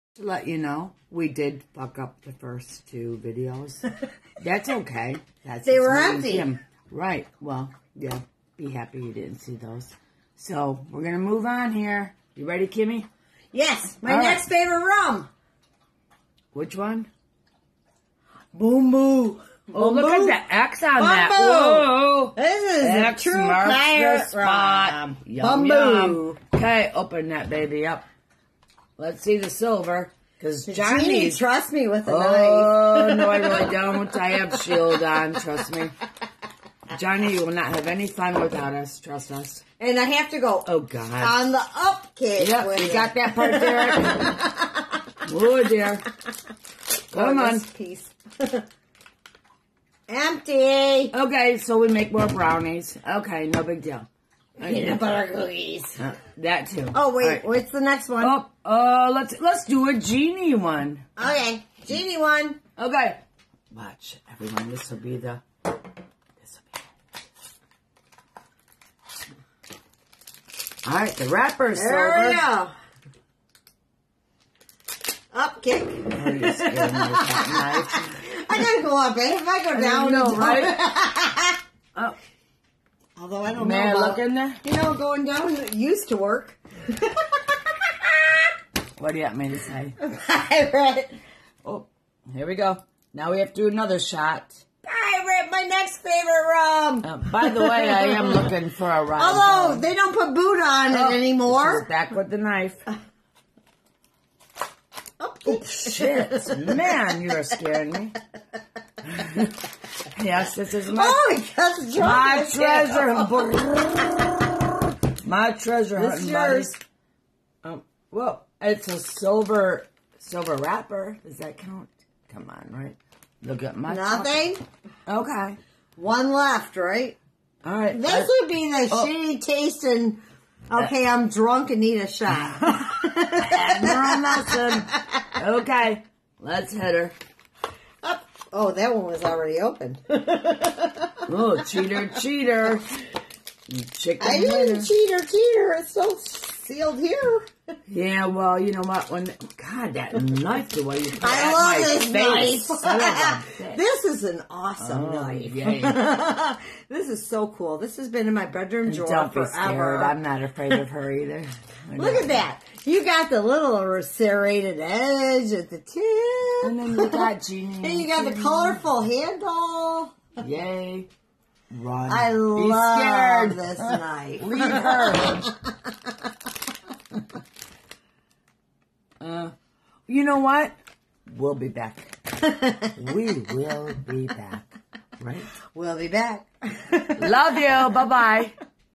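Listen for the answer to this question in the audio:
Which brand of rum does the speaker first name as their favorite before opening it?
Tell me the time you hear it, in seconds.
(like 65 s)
18 s.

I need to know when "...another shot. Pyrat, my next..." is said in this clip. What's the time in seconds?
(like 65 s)
93 s.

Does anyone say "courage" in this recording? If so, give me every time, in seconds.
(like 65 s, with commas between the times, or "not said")
not said.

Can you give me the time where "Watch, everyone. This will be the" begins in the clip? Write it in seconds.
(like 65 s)
63 s.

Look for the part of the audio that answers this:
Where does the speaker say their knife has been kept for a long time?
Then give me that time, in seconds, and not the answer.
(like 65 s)
158 s.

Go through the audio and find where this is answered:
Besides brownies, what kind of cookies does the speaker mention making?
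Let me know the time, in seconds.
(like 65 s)
54 s.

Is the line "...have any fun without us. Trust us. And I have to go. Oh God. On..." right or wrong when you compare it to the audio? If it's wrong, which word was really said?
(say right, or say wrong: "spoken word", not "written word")
right.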